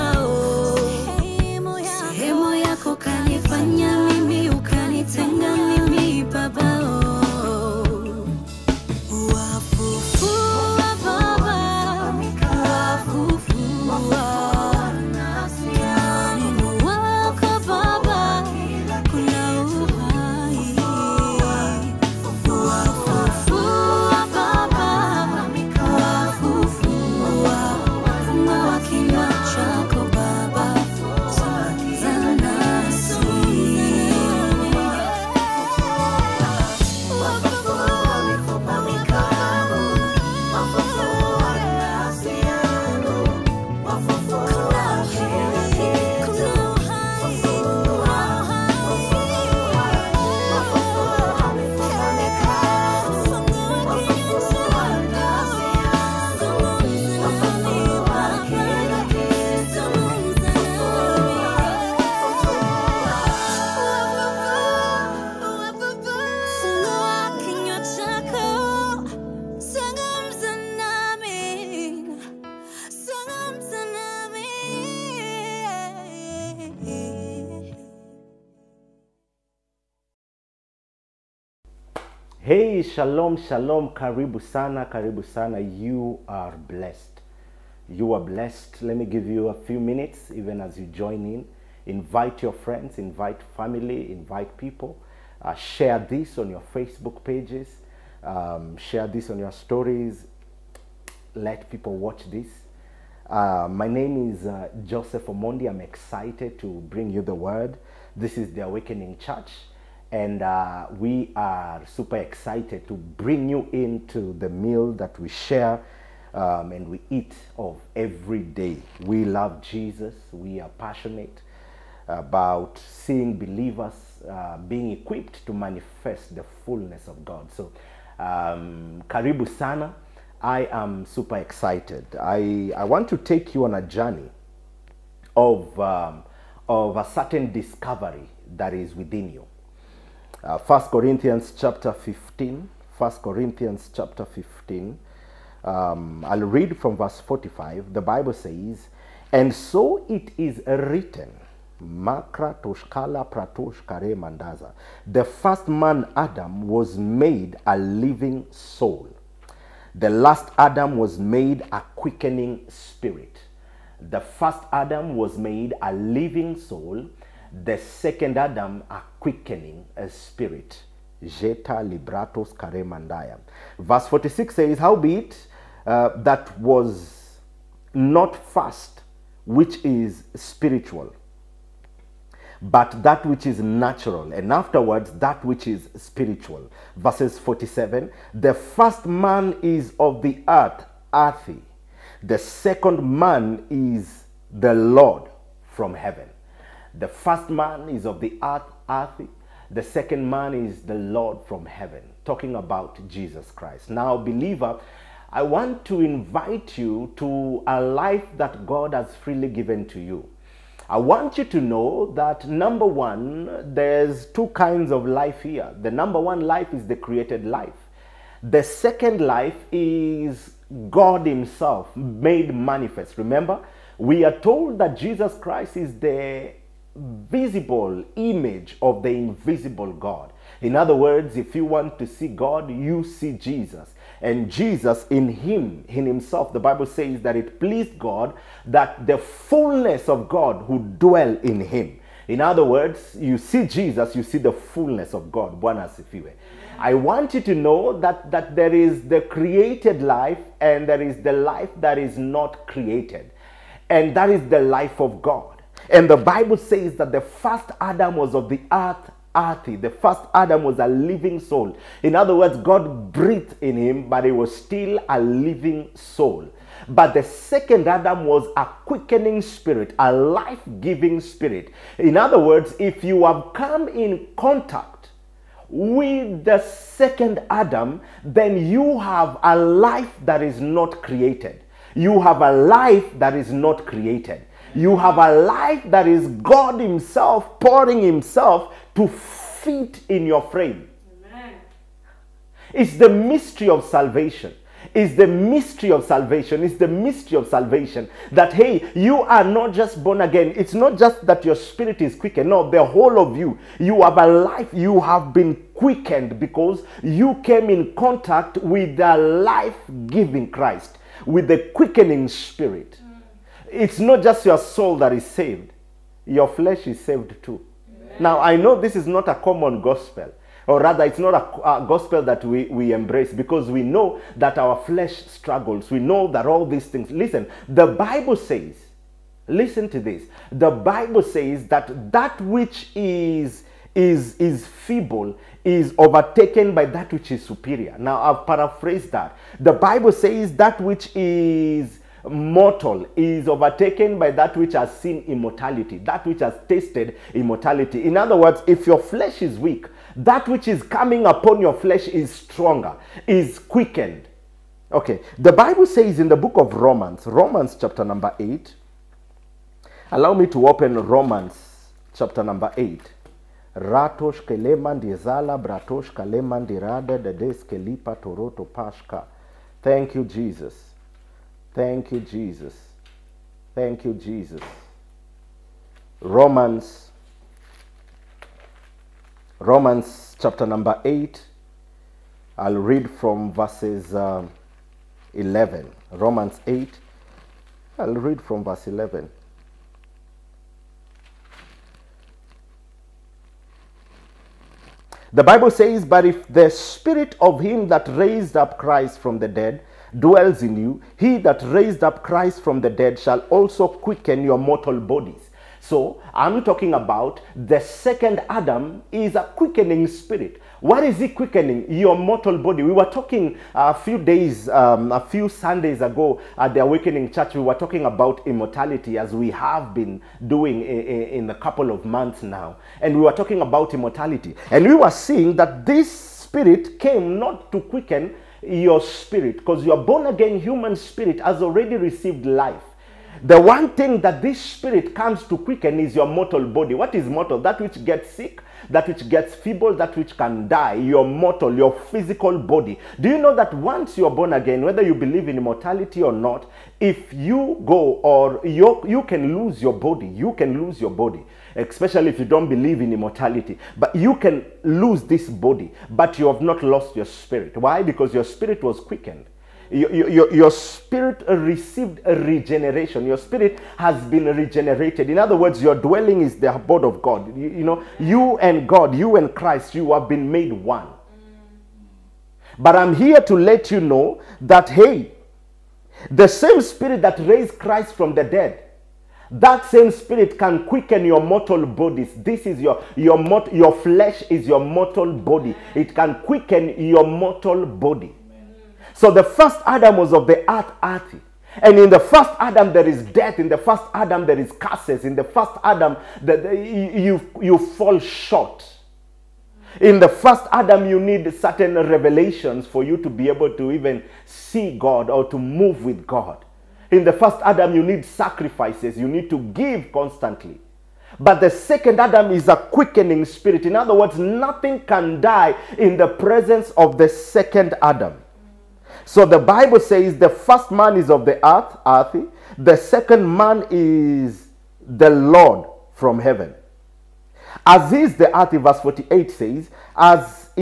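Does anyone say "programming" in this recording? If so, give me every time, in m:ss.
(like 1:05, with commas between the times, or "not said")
not said.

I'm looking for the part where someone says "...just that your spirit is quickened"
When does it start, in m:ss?
5:00.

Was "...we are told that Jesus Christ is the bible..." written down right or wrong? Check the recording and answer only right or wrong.
wrong.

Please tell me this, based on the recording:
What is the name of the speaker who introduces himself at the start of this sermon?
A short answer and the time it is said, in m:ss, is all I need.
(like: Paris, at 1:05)
Joseph Omondi, at 1:44.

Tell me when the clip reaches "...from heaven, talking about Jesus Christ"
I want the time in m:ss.
3:21.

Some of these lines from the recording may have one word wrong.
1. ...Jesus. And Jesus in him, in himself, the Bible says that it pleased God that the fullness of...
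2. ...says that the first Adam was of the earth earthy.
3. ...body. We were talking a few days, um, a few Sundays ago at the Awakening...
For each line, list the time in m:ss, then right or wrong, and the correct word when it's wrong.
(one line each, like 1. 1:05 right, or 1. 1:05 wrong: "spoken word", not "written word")
1. 3:53 right
2. 4:16 right
3. 6:52 right.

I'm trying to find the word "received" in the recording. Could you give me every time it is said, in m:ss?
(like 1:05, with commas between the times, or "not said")
7:11, 7:41.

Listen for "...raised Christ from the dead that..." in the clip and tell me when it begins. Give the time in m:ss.
7:57.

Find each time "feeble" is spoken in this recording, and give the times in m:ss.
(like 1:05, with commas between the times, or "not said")
5:34, 7:19.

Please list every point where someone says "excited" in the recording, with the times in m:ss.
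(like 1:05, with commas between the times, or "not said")
1:45, 1:52, 2:11.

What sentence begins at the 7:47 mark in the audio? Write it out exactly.
You, you know, you and God, you and Christ, you have been made one.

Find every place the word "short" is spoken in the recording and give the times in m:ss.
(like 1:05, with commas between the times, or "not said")
8:18.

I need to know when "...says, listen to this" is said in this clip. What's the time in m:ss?
5:28.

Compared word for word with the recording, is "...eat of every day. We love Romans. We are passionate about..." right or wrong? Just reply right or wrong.
wrong.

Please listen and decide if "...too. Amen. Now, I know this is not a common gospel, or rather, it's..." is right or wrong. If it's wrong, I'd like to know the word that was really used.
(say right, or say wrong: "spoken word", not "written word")
right.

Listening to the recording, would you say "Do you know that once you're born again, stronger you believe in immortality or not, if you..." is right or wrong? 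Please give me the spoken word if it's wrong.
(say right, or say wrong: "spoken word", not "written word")
wrong: "whether", not "stronger".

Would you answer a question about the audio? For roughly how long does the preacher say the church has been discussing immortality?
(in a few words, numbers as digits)
A couple of months.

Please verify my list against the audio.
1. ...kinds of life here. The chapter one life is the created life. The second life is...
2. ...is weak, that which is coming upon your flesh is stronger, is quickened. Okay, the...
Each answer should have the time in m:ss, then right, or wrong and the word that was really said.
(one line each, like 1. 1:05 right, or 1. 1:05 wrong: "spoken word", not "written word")
1. 3:34 wrong: "number", not "chapter"
2. 5:49 right.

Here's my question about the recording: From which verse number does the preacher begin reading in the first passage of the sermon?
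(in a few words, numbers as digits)
45.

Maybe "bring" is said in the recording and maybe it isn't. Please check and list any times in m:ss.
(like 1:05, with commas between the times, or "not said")
1:46, 1:52.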